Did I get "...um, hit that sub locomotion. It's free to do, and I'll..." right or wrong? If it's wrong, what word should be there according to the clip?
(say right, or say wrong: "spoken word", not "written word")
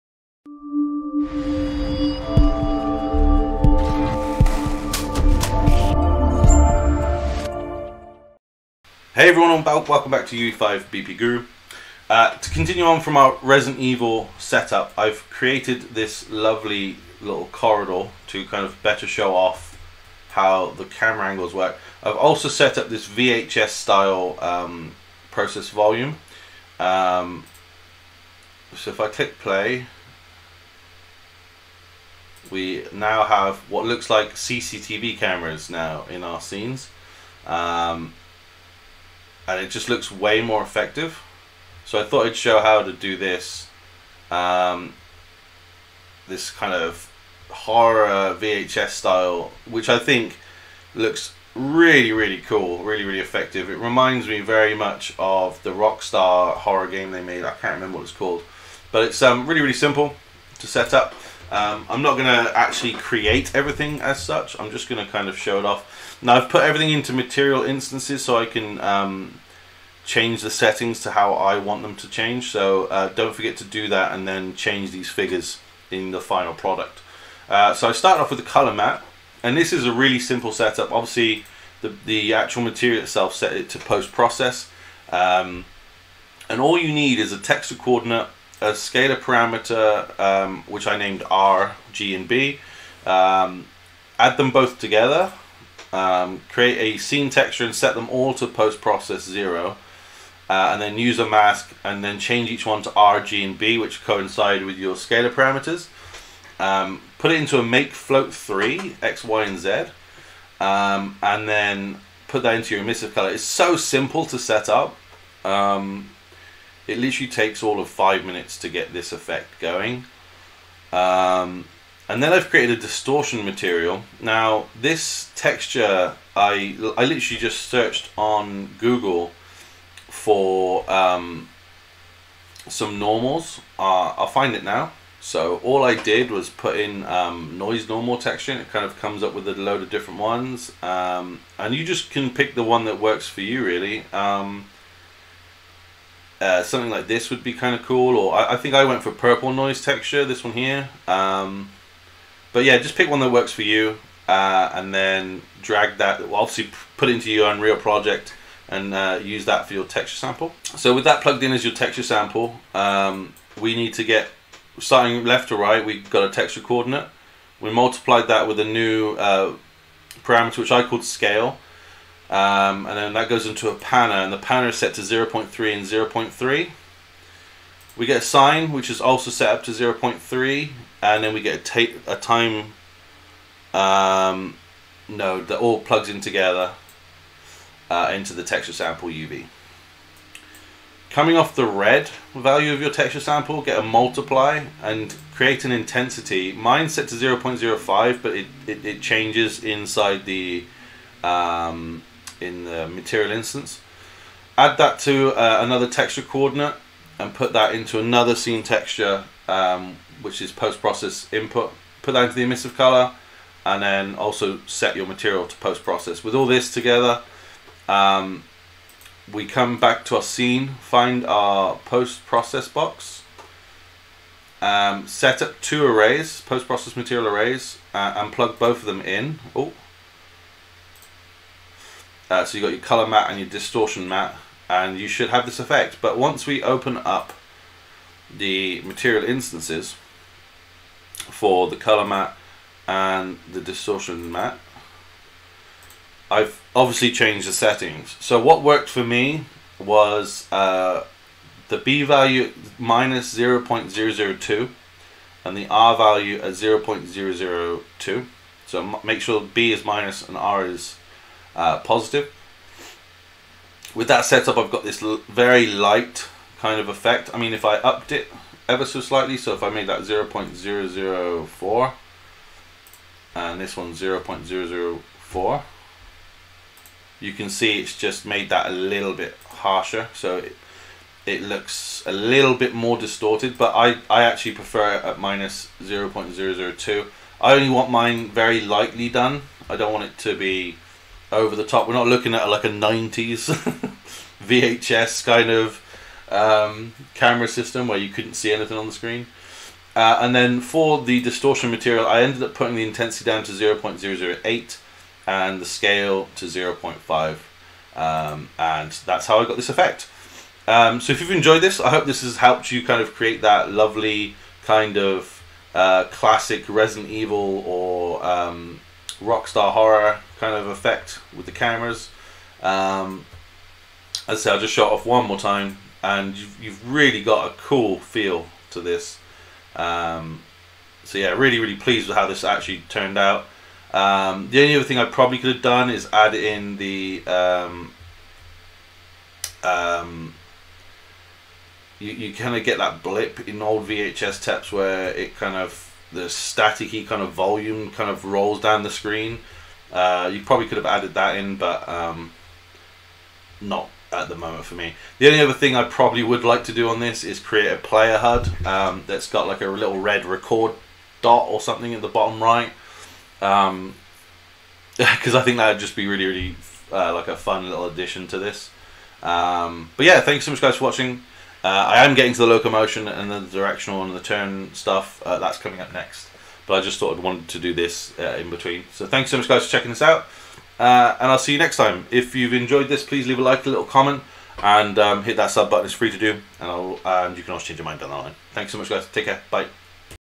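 wrong: "button", not "locomotion".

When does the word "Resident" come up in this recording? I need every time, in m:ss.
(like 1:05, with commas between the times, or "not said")
0:13, 5:16.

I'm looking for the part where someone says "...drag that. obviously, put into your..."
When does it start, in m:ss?
2:35.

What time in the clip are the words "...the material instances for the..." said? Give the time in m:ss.
3:58.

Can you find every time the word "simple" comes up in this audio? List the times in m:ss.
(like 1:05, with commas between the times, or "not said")
0:59, 1:20, 1:53.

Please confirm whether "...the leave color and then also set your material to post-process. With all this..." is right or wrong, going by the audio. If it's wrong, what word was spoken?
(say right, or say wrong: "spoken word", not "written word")
wrong: "emissive", not "leave".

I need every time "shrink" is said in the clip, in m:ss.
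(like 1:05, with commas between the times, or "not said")
not said.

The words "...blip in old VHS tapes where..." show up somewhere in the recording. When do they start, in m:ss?
5:43.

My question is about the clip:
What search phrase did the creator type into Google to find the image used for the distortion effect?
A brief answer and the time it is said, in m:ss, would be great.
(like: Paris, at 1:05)
noise normal texture, at 2:17.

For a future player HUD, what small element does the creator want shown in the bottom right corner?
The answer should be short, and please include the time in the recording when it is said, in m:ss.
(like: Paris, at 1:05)
red record dot, at 5:59.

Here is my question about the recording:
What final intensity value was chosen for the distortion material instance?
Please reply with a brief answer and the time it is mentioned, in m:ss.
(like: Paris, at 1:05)
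0.008, at 5:03.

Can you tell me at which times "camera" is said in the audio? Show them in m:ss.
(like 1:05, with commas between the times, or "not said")
0:20, 0:35, 4:57, 5:21.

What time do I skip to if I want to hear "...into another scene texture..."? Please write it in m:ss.
3:27.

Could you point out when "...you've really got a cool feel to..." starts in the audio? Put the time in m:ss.
5:26.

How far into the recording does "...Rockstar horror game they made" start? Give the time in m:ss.
0:55.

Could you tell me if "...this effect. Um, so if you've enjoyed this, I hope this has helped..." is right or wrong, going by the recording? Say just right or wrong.
right.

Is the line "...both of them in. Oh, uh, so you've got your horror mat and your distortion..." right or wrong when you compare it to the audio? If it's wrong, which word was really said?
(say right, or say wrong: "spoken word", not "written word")
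wrong: "color", not "horror".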